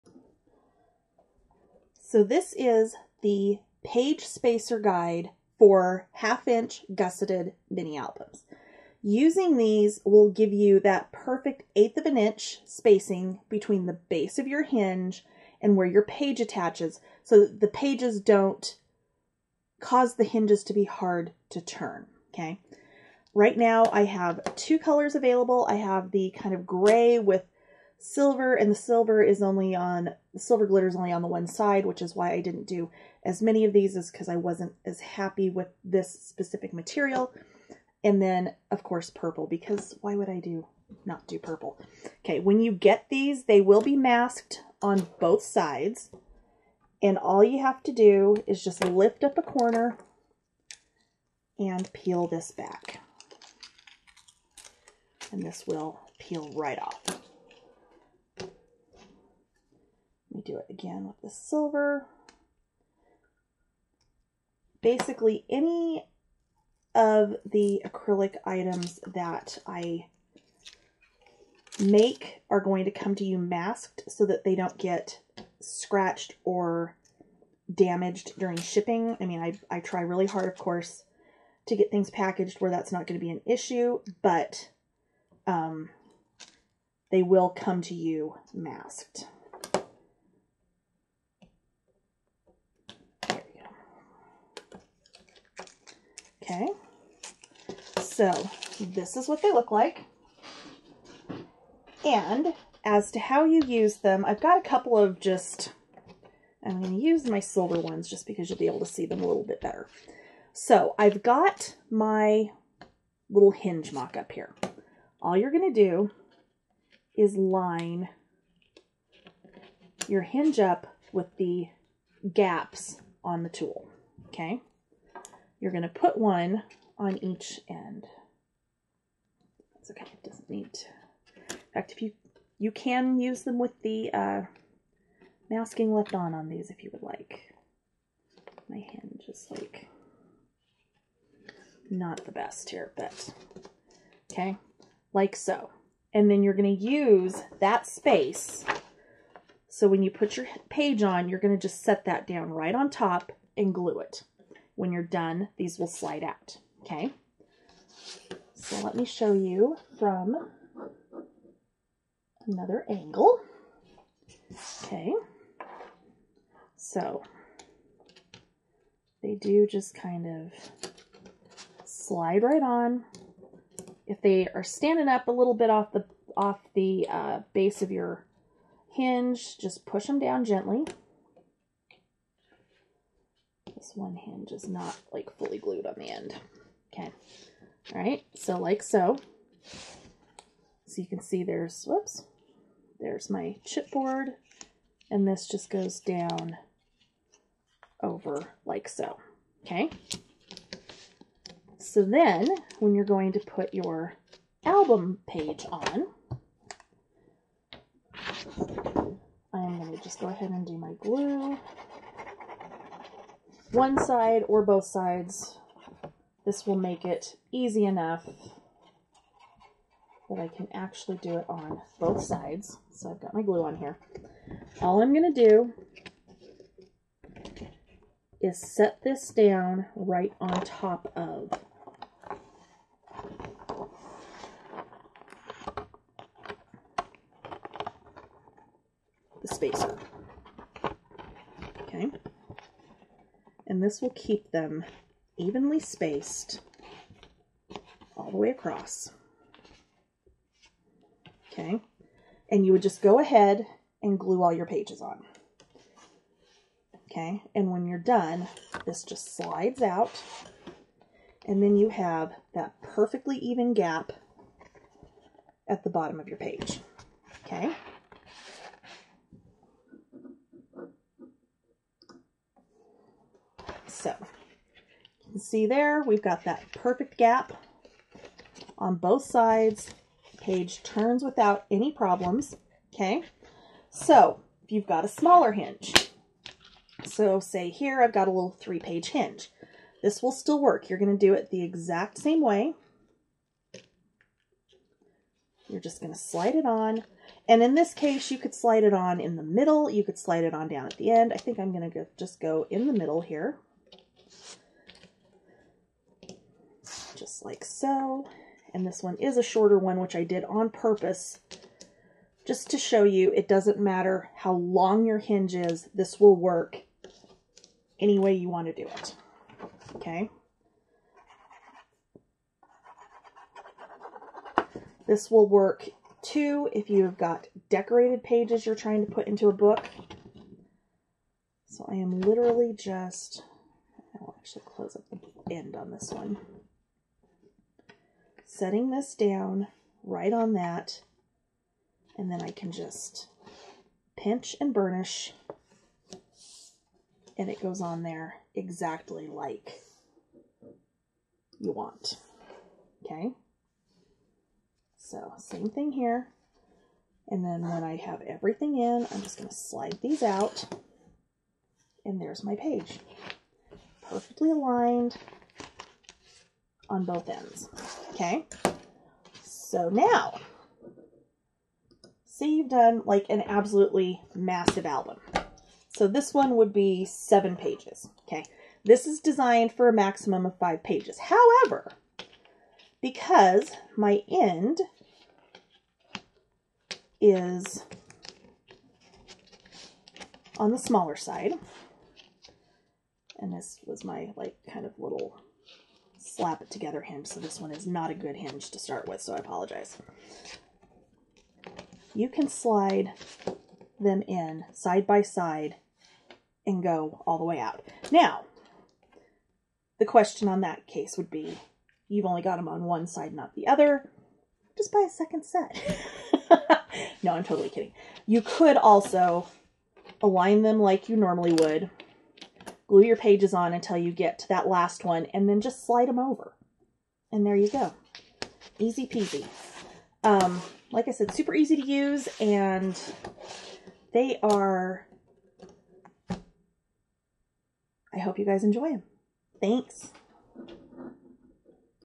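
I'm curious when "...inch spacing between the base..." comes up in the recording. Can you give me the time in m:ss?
0:12.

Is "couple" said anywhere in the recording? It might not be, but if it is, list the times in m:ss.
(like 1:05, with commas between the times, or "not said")
1:44.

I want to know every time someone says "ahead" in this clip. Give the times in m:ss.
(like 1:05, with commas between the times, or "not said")
3:30, 4:13.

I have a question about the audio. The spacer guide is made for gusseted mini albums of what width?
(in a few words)
half inch.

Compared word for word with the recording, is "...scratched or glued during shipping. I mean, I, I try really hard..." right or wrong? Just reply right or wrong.
wrong.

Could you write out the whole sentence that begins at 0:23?
Right now I have two colors available.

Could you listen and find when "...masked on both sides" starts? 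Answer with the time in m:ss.
0:43.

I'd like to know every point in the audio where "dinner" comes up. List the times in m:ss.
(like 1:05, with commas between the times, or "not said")
not said.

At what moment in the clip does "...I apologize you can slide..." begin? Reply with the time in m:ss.
6:39.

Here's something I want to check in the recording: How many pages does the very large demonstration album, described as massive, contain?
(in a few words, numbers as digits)
7.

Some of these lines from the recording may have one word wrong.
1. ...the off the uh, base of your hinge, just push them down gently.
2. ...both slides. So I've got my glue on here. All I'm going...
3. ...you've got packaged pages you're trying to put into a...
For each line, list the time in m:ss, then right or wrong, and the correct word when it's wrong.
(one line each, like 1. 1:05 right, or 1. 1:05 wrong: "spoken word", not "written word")
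1. 2:55 right
2. 3:41 wrong: "sides", not "slides"
3. 5:26 wrong: "decorated", not "packaged".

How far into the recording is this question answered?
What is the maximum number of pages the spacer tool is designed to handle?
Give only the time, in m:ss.
6:20.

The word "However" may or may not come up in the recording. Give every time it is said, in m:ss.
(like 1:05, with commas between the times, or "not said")
6:21.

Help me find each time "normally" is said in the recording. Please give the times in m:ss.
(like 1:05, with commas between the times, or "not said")
7:01.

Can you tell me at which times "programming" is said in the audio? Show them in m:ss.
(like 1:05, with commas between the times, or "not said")
not said.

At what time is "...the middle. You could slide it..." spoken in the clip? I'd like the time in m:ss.
4:59.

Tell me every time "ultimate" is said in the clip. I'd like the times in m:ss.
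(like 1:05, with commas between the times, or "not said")
not said.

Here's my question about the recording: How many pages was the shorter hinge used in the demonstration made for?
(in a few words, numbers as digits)
3.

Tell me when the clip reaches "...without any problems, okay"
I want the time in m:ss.
4:41.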